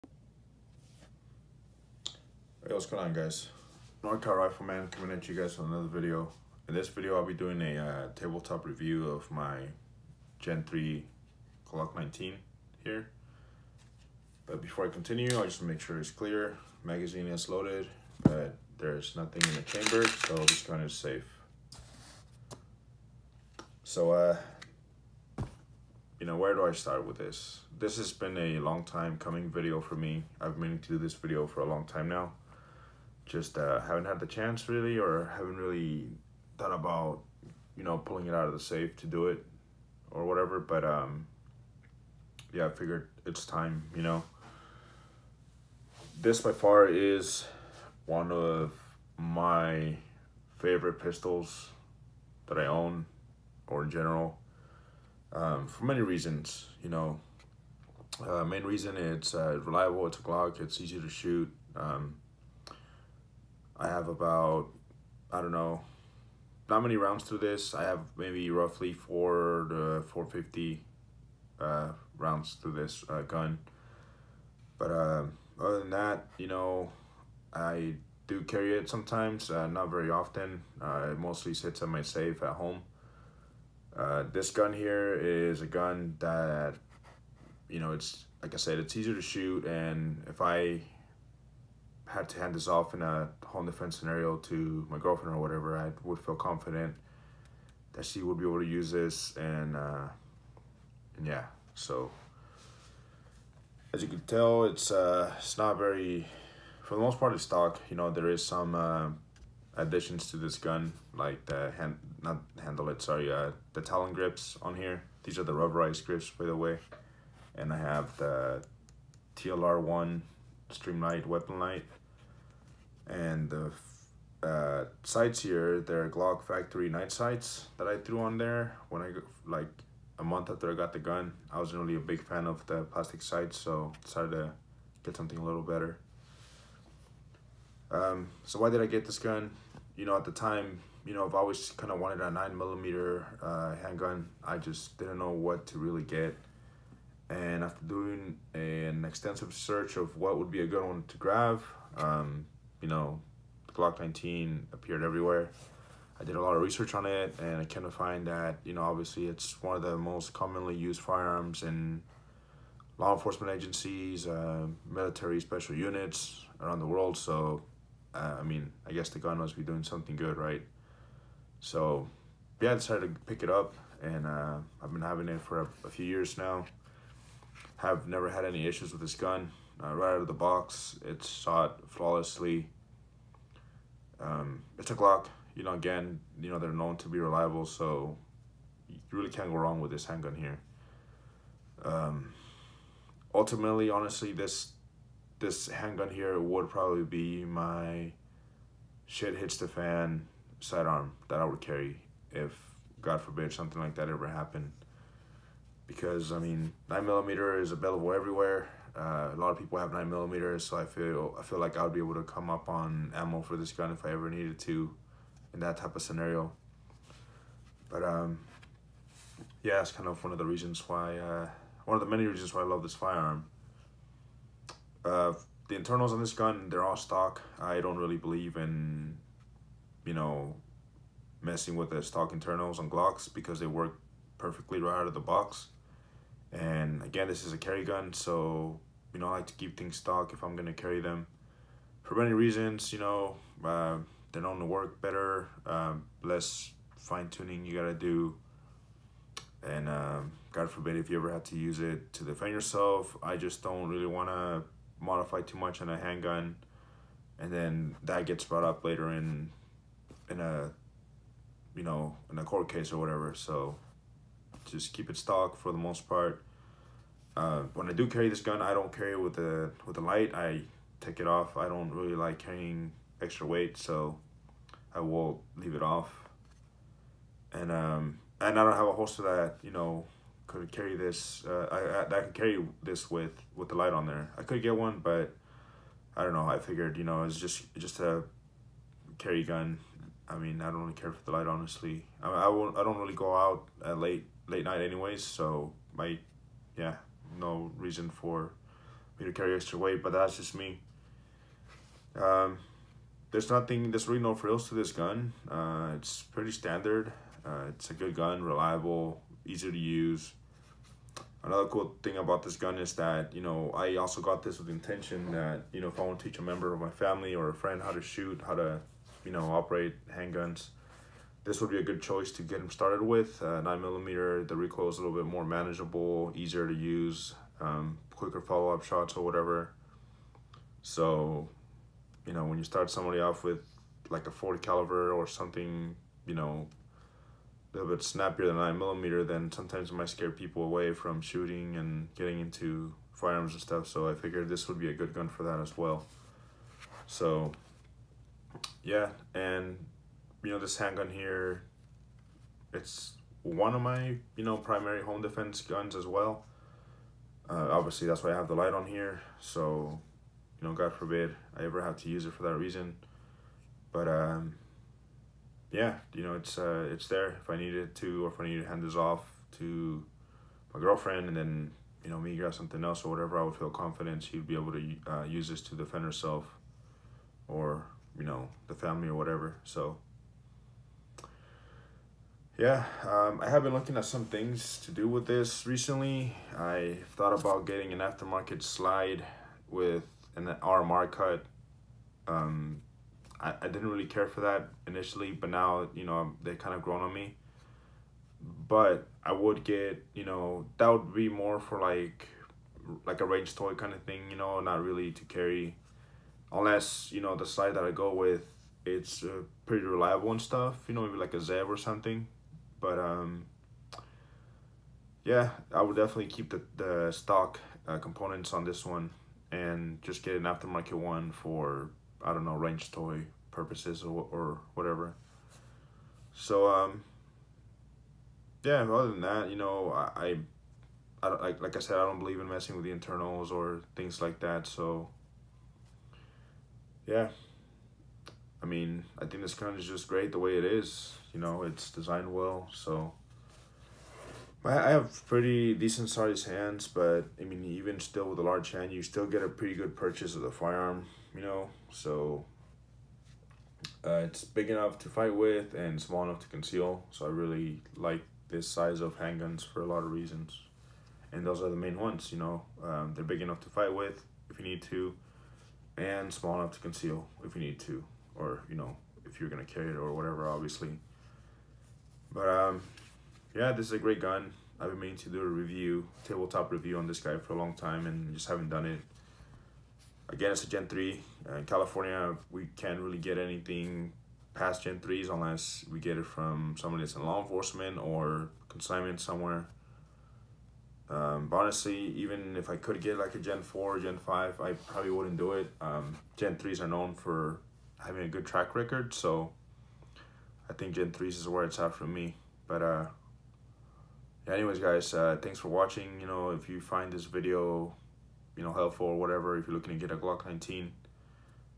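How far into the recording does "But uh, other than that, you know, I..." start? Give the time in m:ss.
1:14.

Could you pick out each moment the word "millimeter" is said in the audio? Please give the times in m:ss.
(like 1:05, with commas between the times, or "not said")
2:22, 3:30, 5:23, 5:38.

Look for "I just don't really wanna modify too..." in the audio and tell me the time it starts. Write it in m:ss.
4:13.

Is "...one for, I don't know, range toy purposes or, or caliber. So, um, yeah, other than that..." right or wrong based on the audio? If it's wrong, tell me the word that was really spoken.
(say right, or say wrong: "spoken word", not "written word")
wrong: "whatever", not "caliber".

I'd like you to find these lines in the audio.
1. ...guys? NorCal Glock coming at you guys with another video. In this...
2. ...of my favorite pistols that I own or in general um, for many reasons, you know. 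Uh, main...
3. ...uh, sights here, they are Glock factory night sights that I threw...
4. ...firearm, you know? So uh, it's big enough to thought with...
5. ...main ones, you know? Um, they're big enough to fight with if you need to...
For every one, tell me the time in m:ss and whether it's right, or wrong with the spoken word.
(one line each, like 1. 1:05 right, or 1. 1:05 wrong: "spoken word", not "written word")
1. 0:03 wrong: "Rifleman", not "Glock"
2. 0:48 right
3. 2:04 right
4. 7:30 wrong: "fight", not "thought"
5. 7:41 right.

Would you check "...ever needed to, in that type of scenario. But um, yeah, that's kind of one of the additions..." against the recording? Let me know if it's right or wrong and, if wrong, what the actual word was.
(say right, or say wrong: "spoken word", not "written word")
wrong: "reasons", not "additions".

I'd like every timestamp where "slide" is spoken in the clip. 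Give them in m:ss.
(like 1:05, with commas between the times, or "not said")
6:28, 6:47.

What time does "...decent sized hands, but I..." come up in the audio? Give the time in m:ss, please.
7:25.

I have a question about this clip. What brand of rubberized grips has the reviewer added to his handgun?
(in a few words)
Talon.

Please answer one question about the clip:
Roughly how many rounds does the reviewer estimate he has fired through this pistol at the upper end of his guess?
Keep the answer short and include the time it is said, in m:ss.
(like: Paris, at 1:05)
450, at 1:10.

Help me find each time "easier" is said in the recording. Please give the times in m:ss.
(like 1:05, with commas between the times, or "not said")
1:28, 5:26.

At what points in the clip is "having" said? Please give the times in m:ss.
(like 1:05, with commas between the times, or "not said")
2:55, 8:18.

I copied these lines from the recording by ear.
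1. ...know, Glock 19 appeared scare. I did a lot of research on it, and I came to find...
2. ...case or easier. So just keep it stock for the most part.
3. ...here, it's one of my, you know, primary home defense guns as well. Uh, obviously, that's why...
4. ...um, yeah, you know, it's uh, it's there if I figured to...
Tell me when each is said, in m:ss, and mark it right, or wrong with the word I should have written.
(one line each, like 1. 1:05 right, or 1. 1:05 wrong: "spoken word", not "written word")
1. 2:32 wrong: "everywhere", not "scare"
2. 4:22 wrong: "whatever", not "easier"
3. 5:51 right
4. 6:04 wrong: "needed", not "figured".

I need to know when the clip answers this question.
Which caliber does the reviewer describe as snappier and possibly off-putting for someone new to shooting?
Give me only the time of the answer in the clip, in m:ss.
5:34.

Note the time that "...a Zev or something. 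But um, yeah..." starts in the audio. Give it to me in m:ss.
6:51.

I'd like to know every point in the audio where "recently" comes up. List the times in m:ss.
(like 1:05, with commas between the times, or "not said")
6:25.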